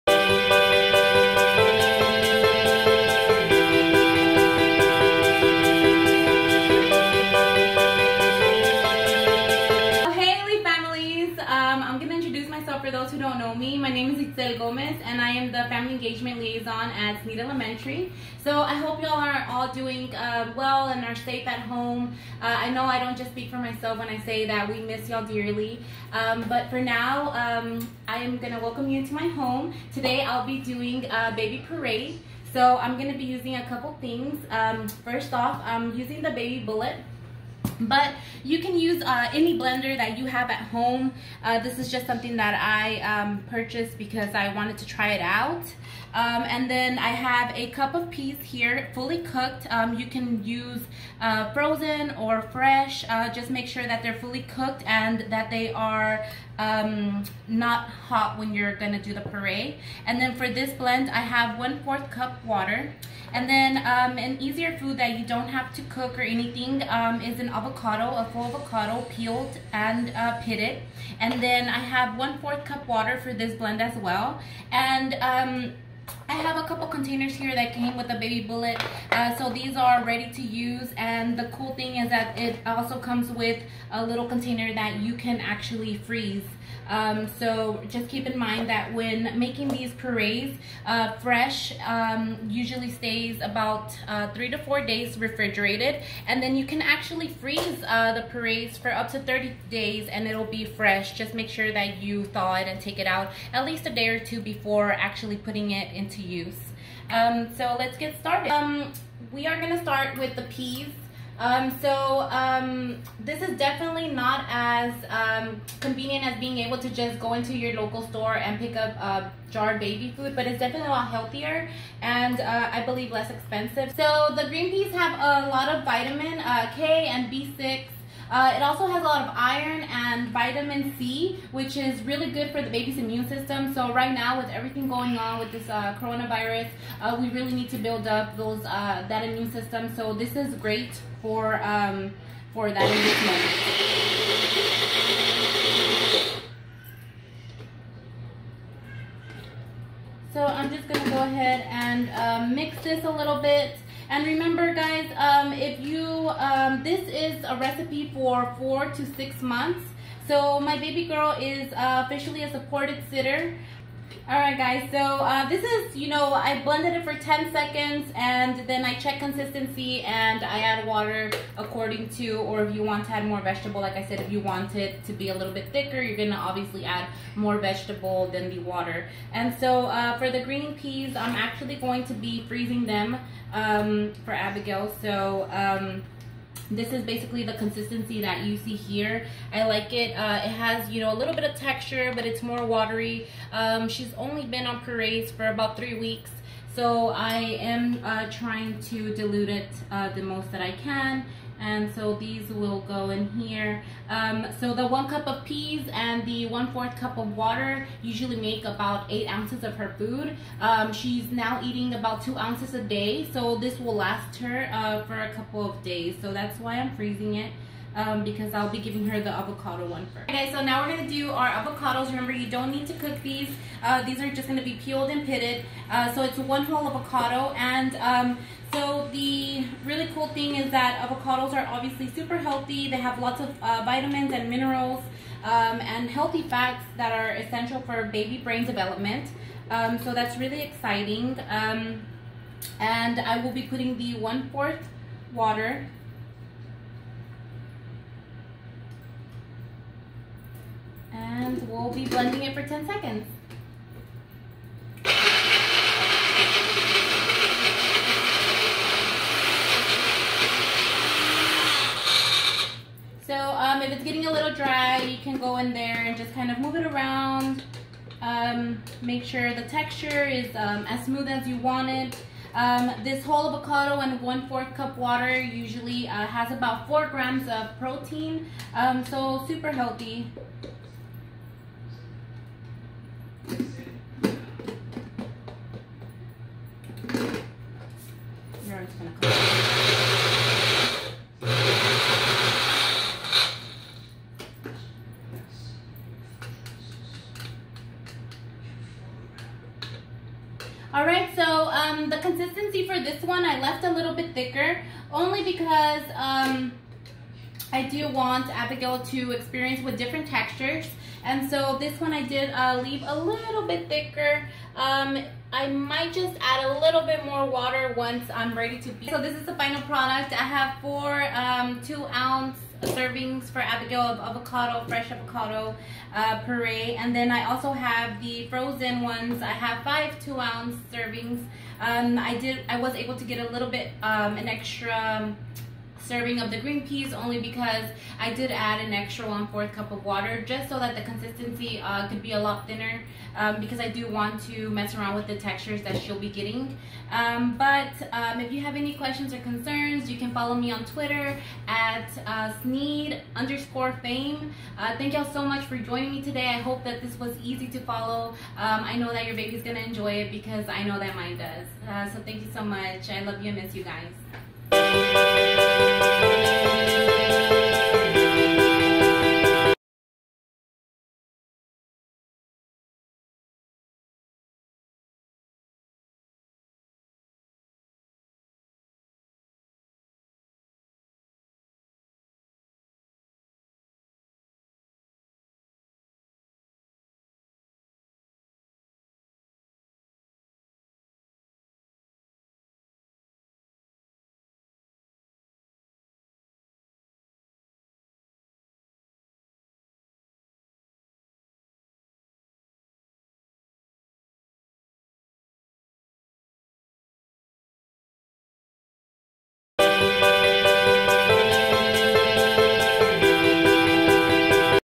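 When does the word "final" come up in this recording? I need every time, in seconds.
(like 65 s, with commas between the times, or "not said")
319 s.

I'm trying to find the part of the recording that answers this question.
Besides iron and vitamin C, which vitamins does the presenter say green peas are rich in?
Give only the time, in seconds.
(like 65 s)
126 s.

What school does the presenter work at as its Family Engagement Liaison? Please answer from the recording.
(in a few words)
Sneed Elementary.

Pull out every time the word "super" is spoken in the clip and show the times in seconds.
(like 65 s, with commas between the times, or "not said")
232 s, 279 s.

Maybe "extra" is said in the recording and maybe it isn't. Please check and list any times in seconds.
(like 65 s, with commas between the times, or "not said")
334 s, 338 s.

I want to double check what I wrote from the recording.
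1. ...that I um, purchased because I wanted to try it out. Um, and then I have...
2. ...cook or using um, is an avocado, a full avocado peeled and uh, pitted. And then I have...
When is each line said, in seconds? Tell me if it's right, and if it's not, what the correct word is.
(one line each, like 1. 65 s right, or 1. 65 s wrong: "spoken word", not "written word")
1. 42 s right
2. 65 s wrong: "anything", not "using".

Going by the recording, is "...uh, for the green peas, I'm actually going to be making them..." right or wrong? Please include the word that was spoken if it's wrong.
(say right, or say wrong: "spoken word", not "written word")
wrong: "freezing", not "making".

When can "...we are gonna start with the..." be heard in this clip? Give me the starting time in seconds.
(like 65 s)
109 s.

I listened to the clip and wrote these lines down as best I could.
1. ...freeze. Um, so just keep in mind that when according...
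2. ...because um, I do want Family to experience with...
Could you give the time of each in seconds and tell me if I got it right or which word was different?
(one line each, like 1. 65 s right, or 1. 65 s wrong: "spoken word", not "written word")
1. 85 s wrong: "making", not "according"
2. 305 s wrong: "Abigail", not "Family".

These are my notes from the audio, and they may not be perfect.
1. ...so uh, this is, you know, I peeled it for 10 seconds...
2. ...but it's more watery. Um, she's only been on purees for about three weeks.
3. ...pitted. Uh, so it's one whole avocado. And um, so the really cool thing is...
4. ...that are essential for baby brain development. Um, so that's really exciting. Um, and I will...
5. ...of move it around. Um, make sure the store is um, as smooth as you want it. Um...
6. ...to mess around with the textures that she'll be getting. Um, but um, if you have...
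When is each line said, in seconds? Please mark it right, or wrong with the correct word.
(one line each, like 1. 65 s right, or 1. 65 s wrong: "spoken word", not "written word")
1. 164 s wrong: "blended", not "peeled"
2. 192 s right
3. 225 s right
4. 236 s right
5. 266 s wrong: "texture", not "store"
6. 344 s right.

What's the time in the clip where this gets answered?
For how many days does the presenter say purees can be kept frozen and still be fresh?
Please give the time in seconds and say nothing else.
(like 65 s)
99 s.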